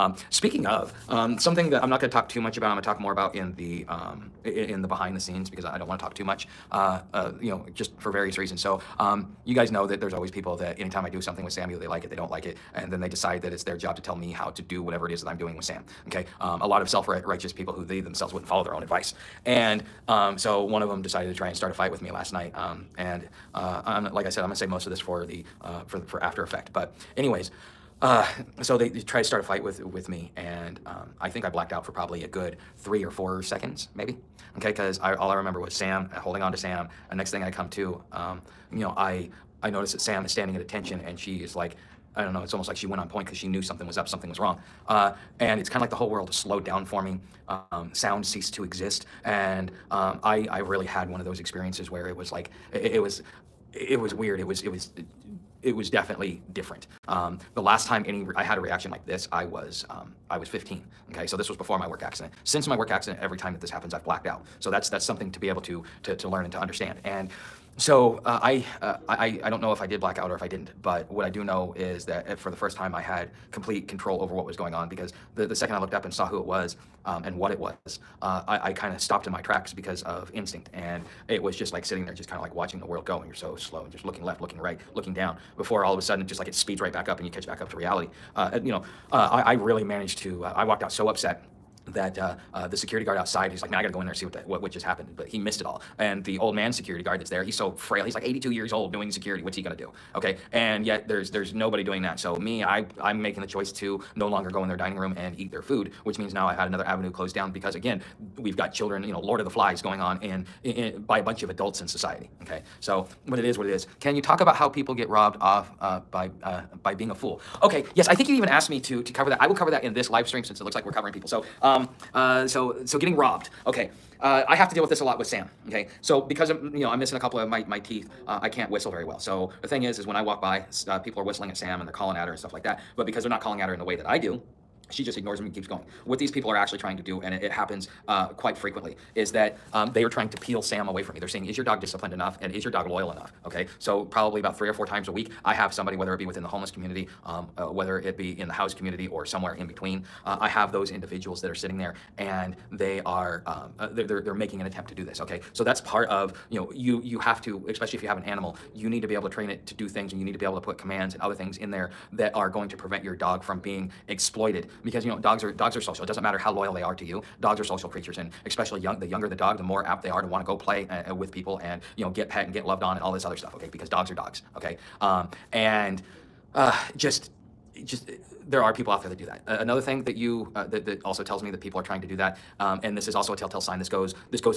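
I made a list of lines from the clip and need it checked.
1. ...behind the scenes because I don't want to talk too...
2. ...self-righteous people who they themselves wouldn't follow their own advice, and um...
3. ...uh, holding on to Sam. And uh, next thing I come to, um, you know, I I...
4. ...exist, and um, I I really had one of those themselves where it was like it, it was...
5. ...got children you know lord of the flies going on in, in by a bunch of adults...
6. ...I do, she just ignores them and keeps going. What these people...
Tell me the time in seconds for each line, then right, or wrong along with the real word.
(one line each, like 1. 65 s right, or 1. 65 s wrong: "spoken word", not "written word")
1. 4 s right
2. 16 s right
3. 36 s right
4. 48 s wrong: "experiences", not "themselves"
5. 108 s right
6. 134 s right.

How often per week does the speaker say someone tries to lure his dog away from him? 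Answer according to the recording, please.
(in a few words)
3 or 4 times.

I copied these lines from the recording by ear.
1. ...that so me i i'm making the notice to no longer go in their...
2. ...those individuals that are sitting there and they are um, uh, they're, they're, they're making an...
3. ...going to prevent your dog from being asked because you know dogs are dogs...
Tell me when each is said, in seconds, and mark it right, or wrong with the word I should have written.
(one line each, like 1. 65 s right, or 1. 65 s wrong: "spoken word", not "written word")
1. 102 s wrong: "choice", not "notice"
2. 150 s right
3. 162 s wrong: "exploited", not "asked".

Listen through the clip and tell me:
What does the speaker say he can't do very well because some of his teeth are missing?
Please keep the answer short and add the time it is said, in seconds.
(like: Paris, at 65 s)
whistle, at 128 s.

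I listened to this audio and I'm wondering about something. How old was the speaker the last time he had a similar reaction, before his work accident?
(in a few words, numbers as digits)
15.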